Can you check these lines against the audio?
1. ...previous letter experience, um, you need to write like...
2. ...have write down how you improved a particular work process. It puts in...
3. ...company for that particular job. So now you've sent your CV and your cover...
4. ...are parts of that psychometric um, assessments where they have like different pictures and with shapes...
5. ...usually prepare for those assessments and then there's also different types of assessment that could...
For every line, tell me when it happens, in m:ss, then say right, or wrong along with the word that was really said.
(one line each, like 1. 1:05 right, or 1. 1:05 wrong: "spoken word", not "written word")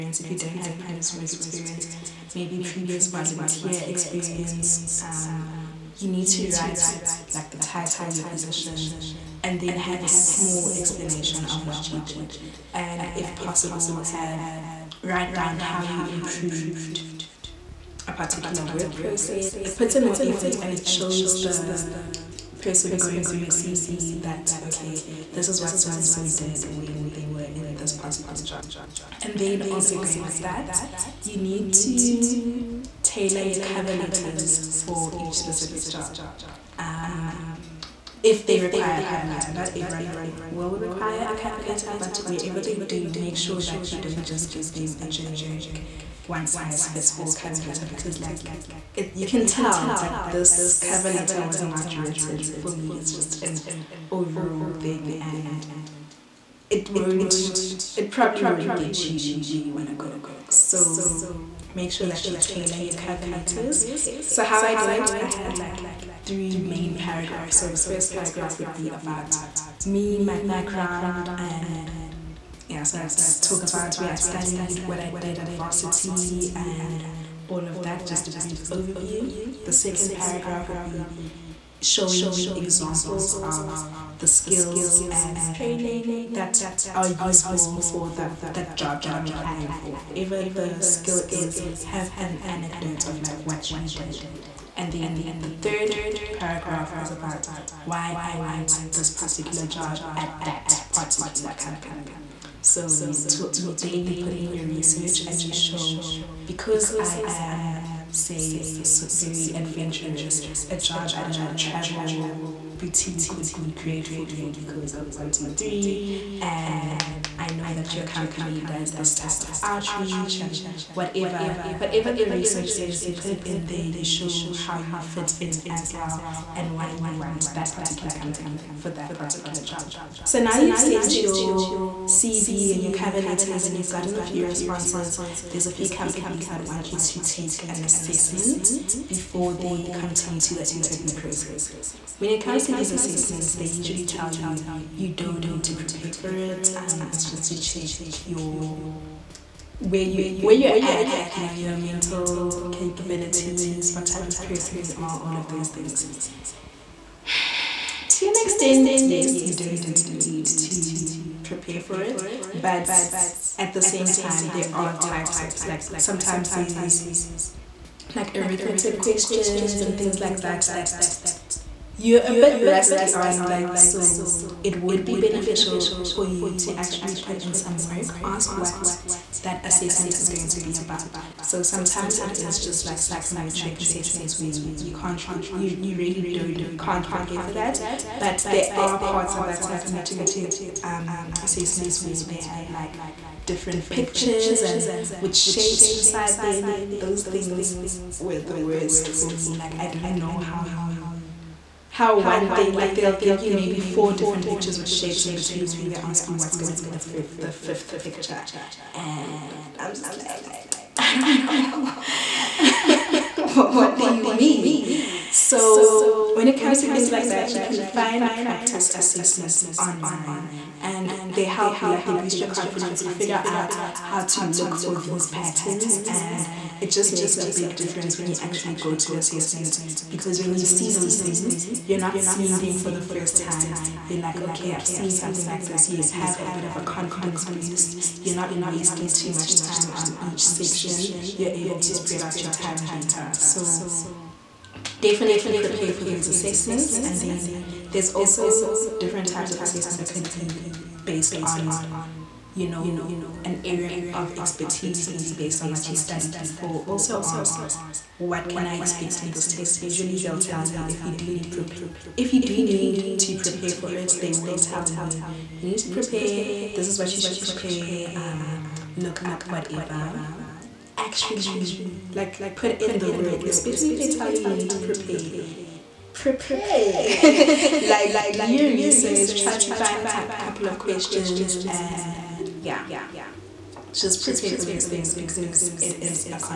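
1. 0:02 wrong: "volunteer", not "letter"
2. 0:13 right
3. 2:08 right
4. 3:08 right
5. 4:04 wrong: "definitely", not "usually".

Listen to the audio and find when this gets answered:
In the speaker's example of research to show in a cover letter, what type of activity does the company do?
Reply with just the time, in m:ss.
1:59.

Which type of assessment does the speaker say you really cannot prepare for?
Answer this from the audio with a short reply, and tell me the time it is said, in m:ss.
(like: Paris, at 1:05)
Psychometric assessments, at 3:03.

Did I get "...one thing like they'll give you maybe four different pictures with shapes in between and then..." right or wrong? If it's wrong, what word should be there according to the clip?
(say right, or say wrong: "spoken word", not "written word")
right.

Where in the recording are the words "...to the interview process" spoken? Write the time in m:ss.
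2:20.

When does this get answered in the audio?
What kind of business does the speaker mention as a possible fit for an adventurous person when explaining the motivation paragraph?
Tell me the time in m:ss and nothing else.
1:51.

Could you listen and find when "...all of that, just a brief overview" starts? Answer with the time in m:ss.
1:17.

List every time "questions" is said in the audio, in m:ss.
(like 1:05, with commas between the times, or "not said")
2:48, 4:40.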